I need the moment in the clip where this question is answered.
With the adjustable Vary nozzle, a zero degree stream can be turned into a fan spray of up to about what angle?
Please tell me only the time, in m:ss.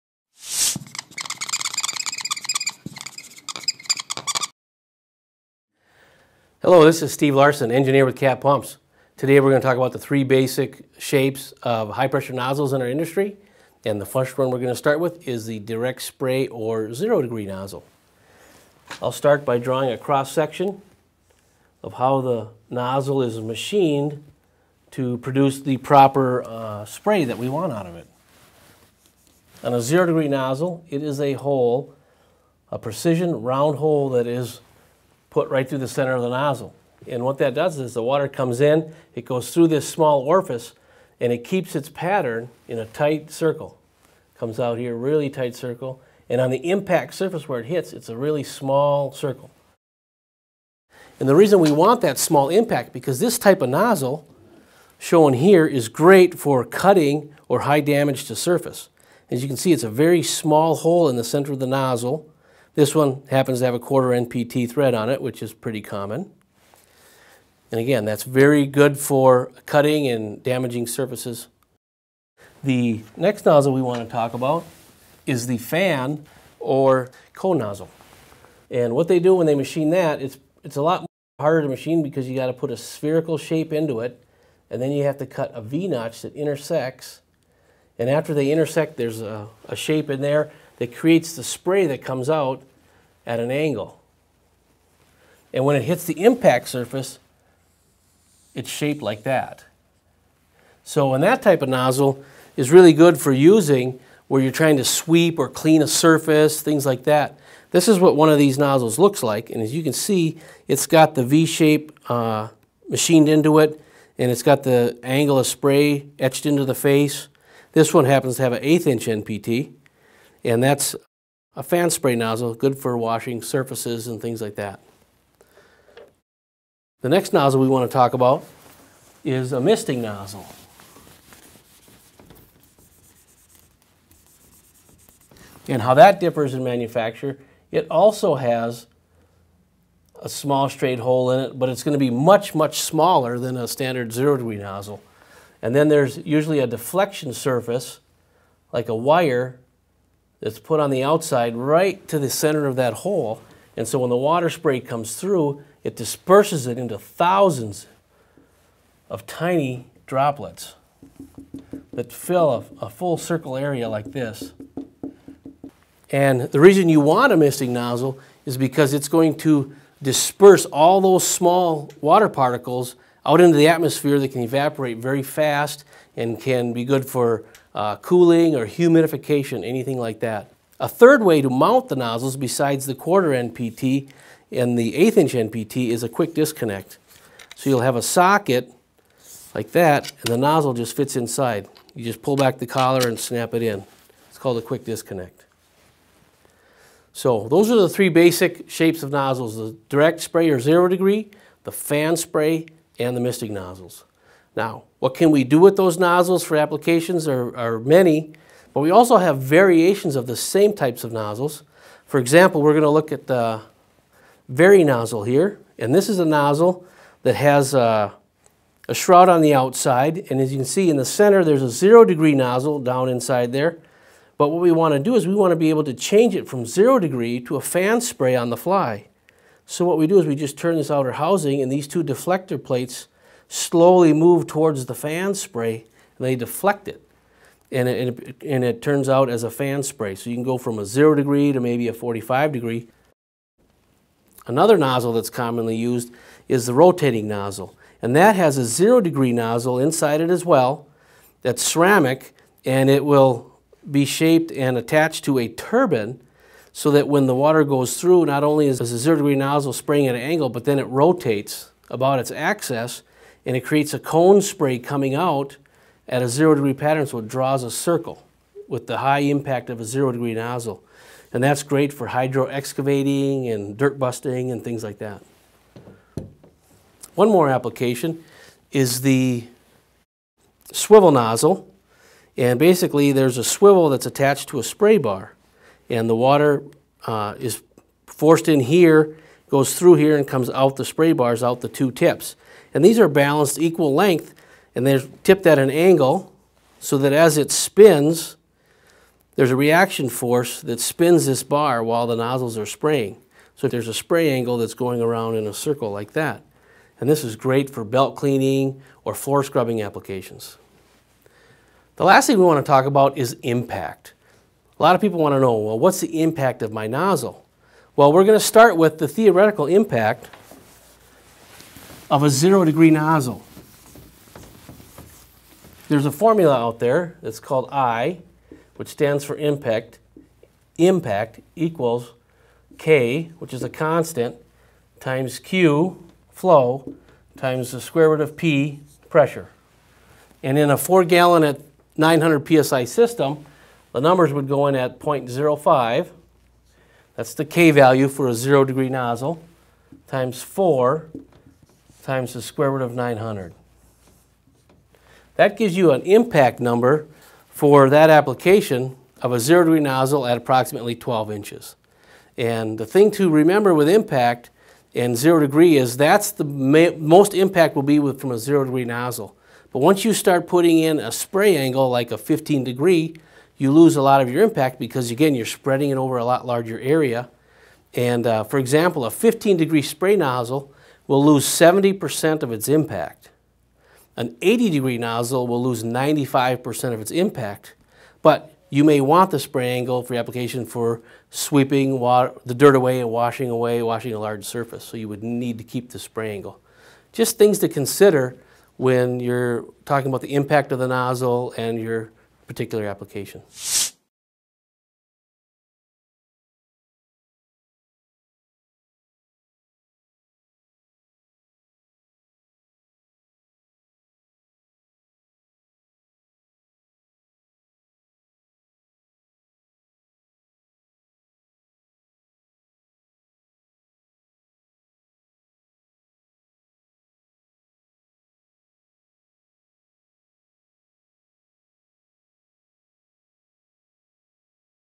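4:01.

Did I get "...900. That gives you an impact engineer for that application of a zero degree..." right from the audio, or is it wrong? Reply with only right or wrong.
wrong.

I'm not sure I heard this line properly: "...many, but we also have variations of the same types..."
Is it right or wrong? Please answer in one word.
right.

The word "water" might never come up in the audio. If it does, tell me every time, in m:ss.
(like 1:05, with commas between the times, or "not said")
0:38, 2:34, 2:52, 4:17, 4:46, 6:31.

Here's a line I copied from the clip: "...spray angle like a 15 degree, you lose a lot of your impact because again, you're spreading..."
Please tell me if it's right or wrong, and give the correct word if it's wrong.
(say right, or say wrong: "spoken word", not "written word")
right.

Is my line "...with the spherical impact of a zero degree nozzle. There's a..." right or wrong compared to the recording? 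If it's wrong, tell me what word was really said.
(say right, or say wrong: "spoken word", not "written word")
wrong: "theoretical", not "spherical".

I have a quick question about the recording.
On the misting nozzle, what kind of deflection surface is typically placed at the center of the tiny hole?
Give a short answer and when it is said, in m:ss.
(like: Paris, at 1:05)
A wire, at 2:28.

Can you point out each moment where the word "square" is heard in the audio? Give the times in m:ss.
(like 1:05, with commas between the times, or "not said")
5:37, 5:52.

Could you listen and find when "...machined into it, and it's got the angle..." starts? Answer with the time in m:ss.
1:52.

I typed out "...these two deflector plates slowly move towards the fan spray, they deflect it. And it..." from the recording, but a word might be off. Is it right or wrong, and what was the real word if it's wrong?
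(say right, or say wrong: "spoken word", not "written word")
right.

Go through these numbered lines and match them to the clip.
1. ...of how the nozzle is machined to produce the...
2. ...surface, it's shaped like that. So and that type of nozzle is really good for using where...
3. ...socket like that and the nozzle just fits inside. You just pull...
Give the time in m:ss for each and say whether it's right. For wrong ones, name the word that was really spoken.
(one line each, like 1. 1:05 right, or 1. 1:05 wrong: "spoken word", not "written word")
1. 0:21 right
2. 1:36 right
3. 3:08 right.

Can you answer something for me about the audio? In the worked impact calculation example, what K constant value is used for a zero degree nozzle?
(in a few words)
0.05.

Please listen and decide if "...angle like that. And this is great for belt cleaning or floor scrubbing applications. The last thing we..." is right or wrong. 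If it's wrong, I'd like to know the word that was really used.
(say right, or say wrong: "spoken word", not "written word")
wrong: "circle", not "angle".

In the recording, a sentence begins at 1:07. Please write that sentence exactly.
And again, that's very good for cutting and damaging surfaces.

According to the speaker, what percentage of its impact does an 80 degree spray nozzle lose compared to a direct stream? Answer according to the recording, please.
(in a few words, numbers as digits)
95%.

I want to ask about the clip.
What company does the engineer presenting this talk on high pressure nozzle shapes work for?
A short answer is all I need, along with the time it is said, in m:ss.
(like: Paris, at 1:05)
Cat Pumps, at 0:08.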